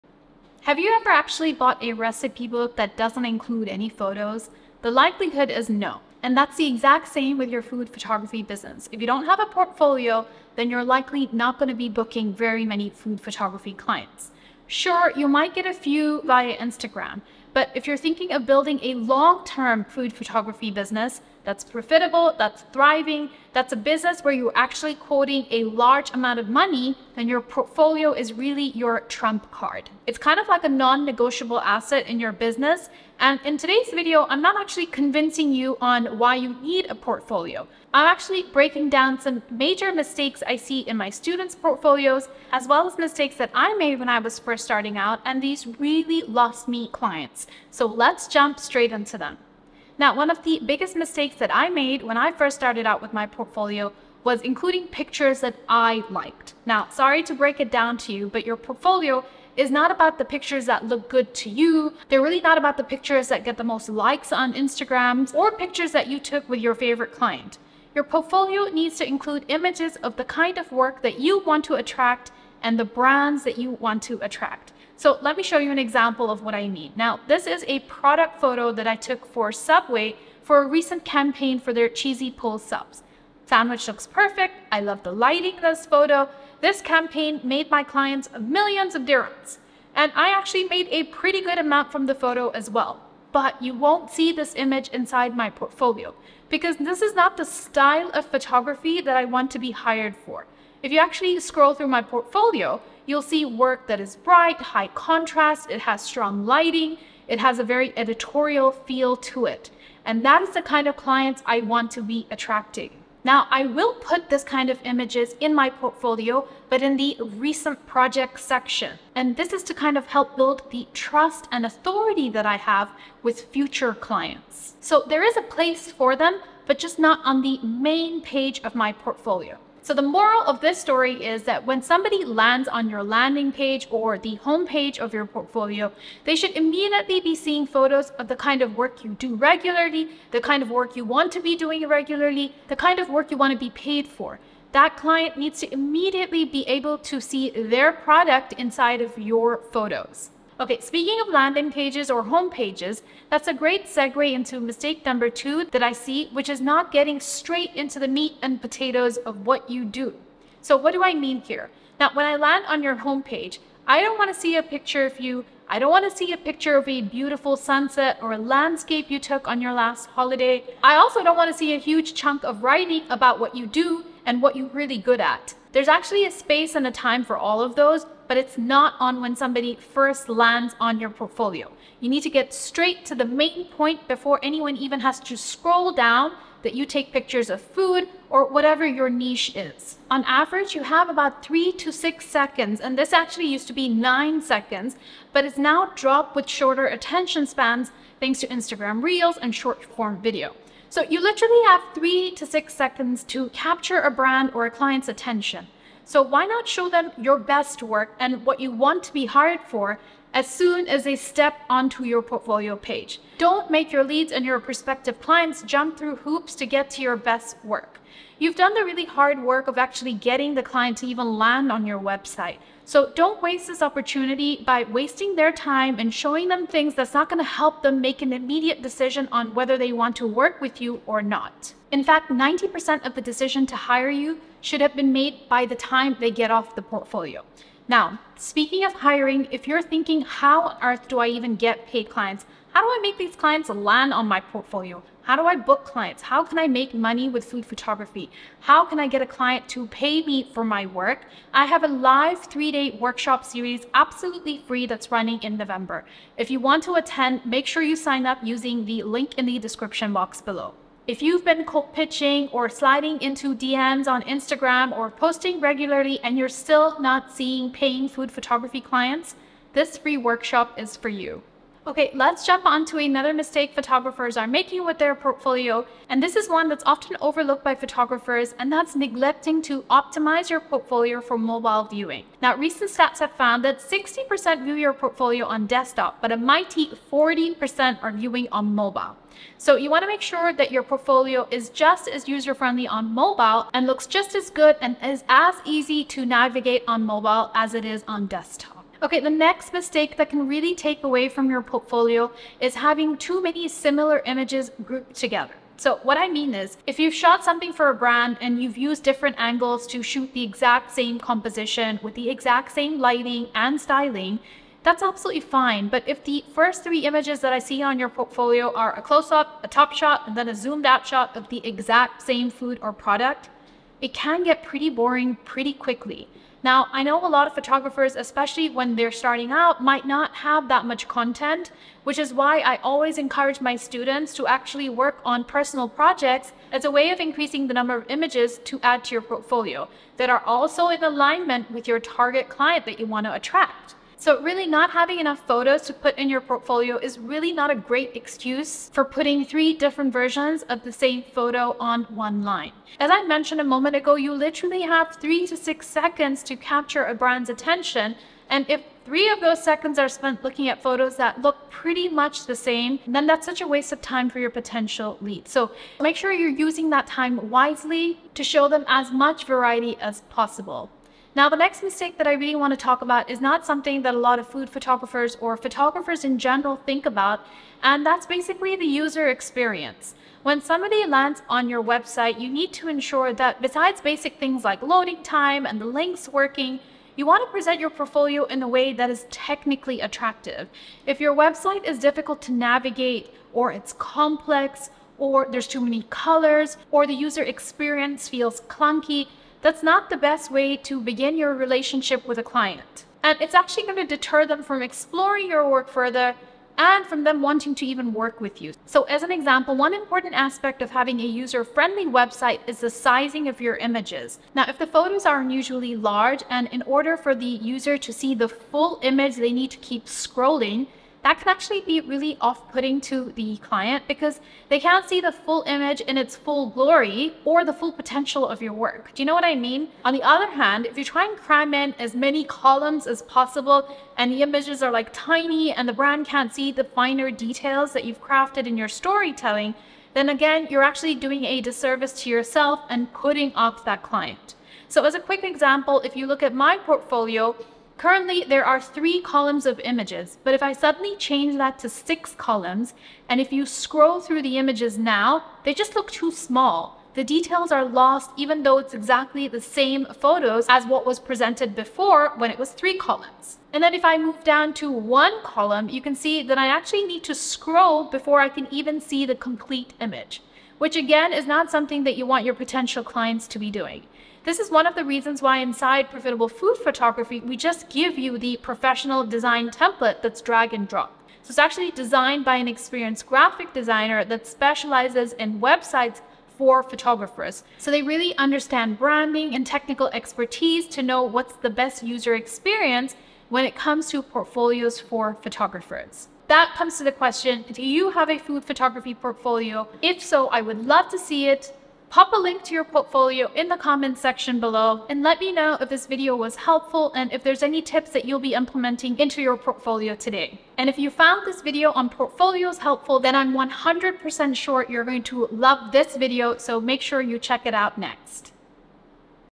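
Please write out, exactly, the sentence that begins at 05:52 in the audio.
As I mentioned a moment ago, you literally have three to six seconds to capture a brand's attention.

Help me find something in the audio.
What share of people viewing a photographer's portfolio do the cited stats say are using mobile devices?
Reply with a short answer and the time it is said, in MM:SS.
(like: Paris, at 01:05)
40%, at 04:47.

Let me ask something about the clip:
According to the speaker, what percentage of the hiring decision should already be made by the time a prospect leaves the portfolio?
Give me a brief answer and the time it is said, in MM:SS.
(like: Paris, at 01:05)
90%, at 03:52.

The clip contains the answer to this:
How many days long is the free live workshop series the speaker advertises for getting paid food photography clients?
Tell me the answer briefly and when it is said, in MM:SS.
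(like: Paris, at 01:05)
3, at 04:12.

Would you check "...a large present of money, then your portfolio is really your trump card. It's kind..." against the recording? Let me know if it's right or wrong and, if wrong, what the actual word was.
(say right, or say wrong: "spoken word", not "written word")
wrong: "amount", not "present".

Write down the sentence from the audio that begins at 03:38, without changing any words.
You've done the really hard work of actually getting the client to even land on your website.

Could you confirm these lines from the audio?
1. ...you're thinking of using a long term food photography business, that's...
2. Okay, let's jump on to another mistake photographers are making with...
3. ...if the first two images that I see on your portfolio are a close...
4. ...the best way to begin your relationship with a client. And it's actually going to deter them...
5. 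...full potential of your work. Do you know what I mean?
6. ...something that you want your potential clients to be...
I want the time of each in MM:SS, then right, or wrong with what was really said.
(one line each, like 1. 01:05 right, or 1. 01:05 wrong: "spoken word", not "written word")
1. 00:17 wrong: "building", not "using"
2. 04:31 right
3. 05:16 wrong: "three", not "two"
4. 06:40 right
5. 07:07 right
6. 07:51 right.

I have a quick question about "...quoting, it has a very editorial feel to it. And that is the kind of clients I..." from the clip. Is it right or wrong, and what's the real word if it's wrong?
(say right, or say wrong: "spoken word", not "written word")
wrong: "lighting", not "quoting".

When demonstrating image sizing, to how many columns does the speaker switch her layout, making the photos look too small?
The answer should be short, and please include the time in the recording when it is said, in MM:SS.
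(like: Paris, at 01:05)
6, at 07:31.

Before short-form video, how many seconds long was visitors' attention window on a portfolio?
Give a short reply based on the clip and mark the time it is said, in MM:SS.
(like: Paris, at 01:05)
9, at 03:13.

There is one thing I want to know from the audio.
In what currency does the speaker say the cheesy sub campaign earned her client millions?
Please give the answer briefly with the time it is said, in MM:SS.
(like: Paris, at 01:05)
dirhams, at 01:29.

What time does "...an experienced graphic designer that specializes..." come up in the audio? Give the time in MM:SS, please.
08:02.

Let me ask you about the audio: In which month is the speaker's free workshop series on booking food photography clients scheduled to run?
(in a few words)
November.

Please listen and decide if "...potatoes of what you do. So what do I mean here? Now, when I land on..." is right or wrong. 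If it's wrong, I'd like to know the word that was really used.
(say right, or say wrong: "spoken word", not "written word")
right.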